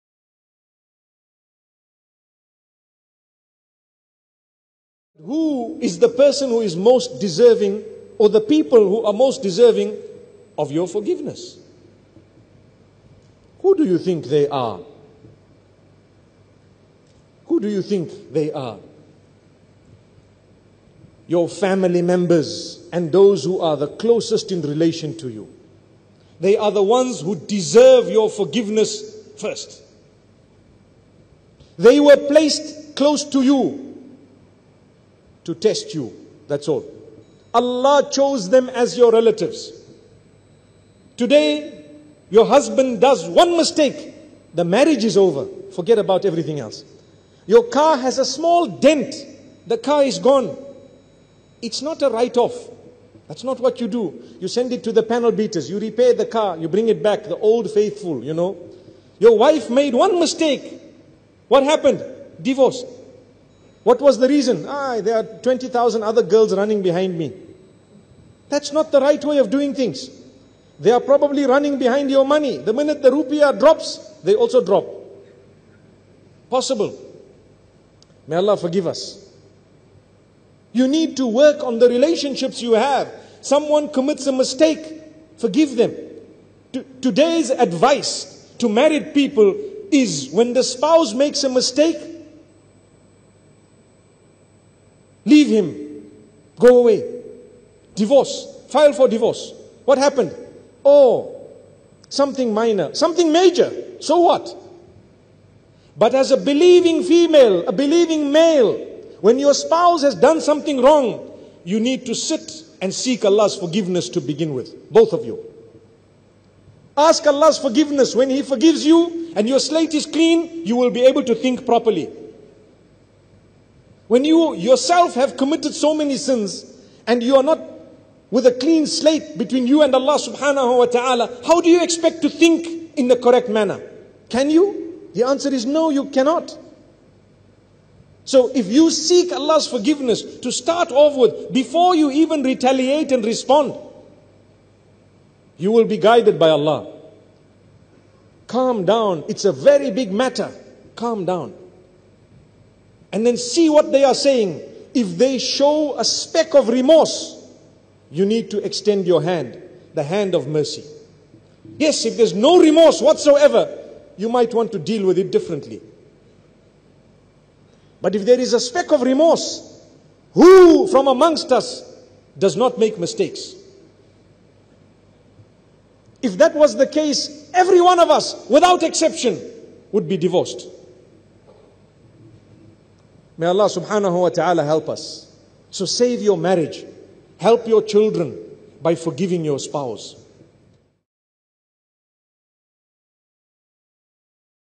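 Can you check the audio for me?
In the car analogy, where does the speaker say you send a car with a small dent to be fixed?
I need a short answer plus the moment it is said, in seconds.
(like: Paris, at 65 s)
Panel beaters, at 55 s.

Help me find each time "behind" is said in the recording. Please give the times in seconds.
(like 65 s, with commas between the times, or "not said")
66 s, 71 s.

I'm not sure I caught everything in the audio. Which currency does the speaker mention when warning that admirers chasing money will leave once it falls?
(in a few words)
Rupiah.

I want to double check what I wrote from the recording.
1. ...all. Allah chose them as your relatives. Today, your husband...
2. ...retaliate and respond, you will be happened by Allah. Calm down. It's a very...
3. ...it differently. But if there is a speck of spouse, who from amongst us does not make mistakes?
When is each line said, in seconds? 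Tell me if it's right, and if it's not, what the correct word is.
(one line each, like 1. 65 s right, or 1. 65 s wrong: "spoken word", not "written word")
1. 36 s right
2. 142 s wrong: "guided", not "happened"
3. 165 s wrong: "remorse", not "spouse".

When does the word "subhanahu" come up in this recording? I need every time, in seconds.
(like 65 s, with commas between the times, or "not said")
130 s, 183 s.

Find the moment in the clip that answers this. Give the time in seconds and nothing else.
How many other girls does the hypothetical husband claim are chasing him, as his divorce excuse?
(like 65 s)
65 s.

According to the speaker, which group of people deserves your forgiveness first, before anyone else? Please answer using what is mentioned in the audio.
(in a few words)
Family members.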